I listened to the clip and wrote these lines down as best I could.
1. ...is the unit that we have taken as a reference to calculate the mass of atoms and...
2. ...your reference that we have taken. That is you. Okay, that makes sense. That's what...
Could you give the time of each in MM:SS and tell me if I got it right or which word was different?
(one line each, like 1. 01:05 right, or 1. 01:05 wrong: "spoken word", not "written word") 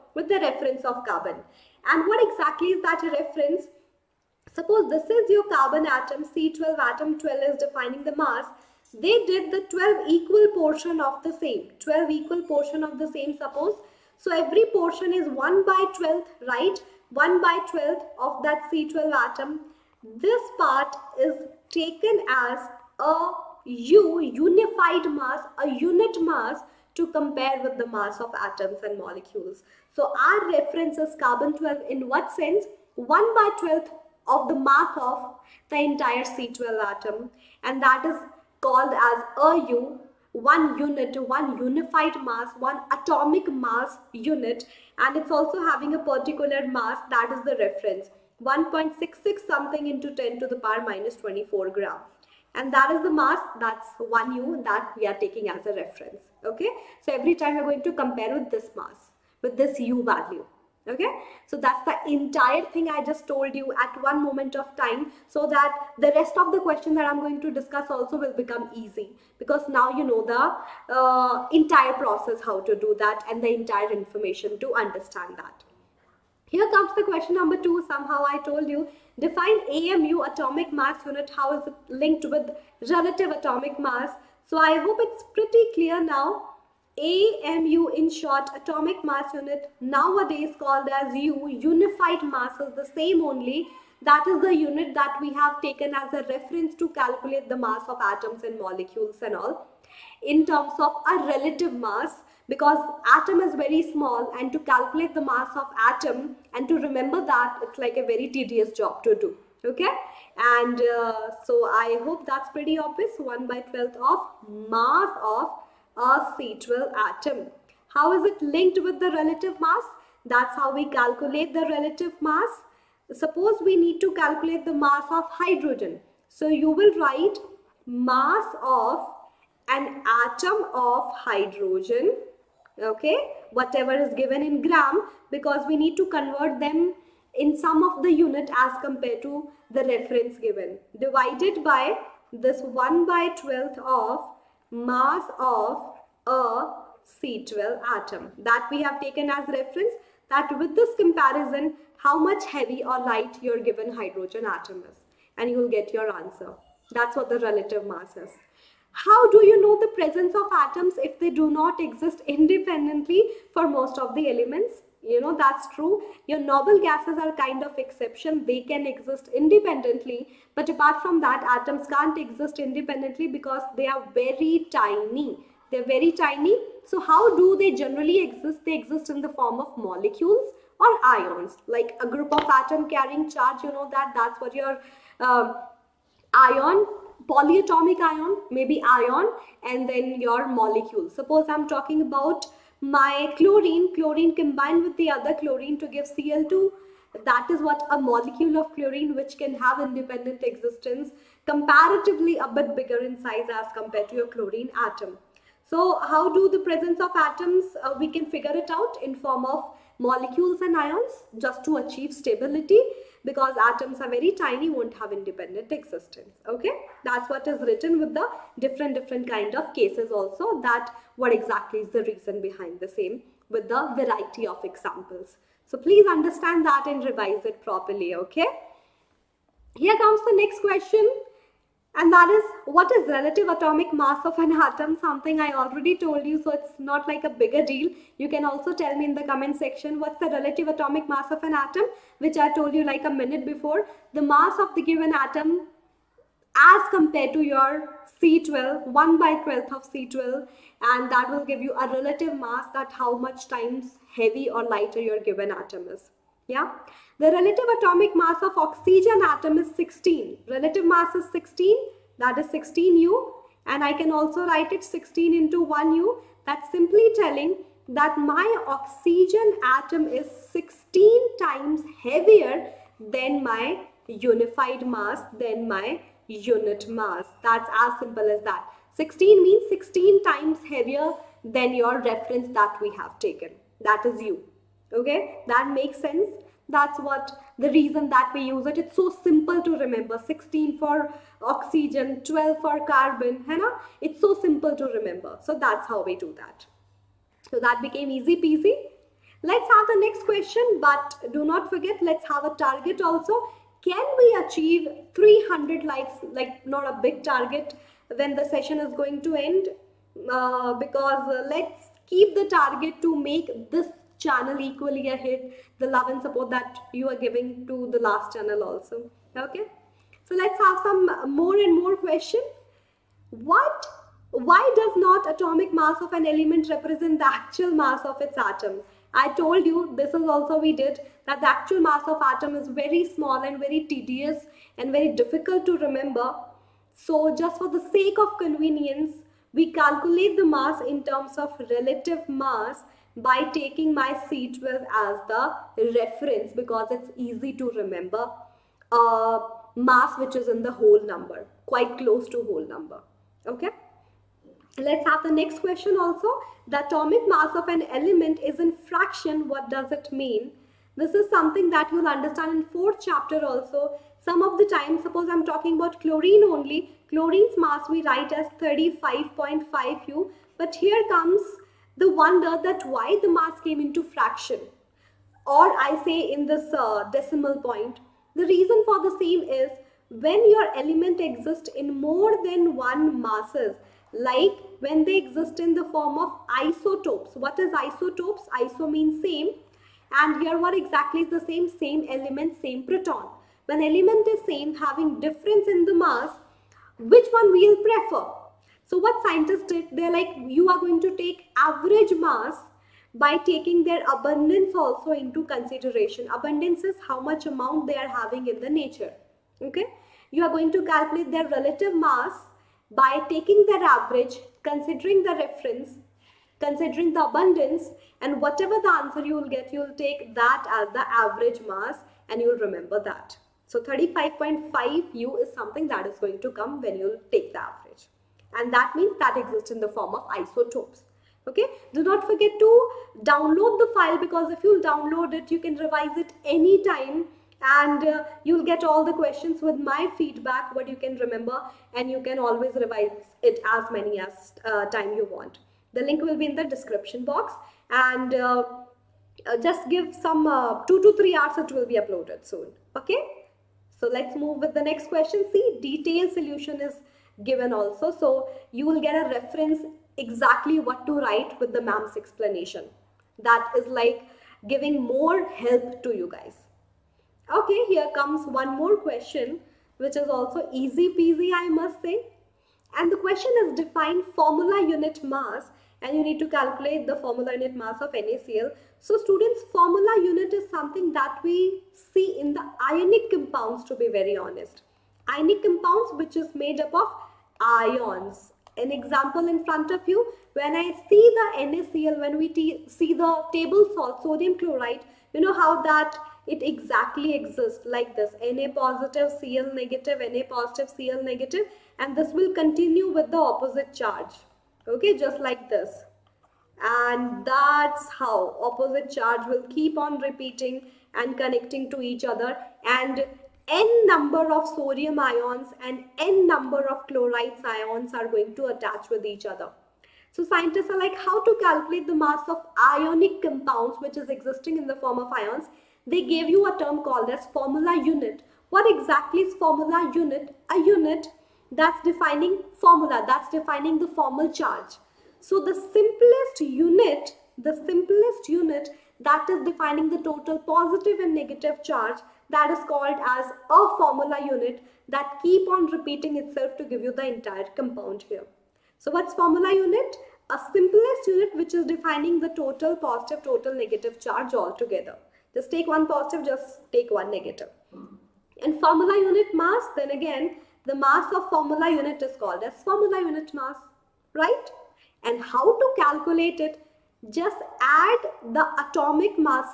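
1. 01:34 right
2. 04:41 right.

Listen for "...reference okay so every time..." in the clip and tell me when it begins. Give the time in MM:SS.
00:55.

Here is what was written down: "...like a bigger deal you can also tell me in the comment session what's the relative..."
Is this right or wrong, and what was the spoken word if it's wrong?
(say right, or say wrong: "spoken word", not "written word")
wrong: "section", not "session".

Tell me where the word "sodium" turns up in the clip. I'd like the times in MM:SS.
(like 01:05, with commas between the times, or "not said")
08:14, 08:34.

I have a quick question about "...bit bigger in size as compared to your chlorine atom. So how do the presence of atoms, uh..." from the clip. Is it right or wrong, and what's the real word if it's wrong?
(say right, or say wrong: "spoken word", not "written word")
right.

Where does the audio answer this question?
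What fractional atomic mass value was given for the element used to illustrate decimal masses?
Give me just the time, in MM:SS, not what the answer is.
06:08.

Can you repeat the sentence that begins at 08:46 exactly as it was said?
They gave you a term called as formula unit.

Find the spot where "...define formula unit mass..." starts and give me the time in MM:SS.
07:53.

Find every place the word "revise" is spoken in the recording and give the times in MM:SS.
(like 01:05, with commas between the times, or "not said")
03:47, 07:15, 07:22.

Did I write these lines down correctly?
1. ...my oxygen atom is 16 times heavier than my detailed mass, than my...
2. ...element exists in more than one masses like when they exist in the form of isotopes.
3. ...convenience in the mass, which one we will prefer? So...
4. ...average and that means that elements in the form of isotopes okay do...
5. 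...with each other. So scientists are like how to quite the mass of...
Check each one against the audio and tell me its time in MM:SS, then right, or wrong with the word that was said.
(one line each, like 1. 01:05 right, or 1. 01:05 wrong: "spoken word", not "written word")
1. 04:28 wrong: "unified", not "detailed"
2. 06:20 right
3. 06:35 wrong: "difference", not "convenience"
4. 07:07 wrong: "exists", not "elements"
5. 08:39 wrong: "calculate", not "quite".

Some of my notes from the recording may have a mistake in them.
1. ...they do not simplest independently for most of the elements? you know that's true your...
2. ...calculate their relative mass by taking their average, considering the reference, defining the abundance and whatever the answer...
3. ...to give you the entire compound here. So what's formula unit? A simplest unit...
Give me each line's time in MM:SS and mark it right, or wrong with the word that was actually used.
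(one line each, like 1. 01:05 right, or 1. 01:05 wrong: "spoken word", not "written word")
1. 02:41 wrong: "exist", not "simplest"
2. 06:50 wrong: "considering", not "defining"
3. 09:06 right.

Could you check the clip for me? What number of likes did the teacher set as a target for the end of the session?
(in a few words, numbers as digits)
300.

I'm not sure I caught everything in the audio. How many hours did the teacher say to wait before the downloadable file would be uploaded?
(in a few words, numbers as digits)
Two to three hours.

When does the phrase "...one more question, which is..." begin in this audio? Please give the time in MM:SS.
07:48.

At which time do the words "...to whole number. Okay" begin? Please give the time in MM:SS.
05:52.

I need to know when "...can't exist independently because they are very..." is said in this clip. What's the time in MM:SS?
02:51.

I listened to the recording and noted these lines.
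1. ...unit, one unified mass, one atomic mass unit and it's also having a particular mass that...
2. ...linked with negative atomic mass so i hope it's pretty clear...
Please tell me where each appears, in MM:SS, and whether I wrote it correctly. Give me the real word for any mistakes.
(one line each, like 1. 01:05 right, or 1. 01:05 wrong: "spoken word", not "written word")
1. 00:40 right
2. 01:22 wrong: "relative", not "negative".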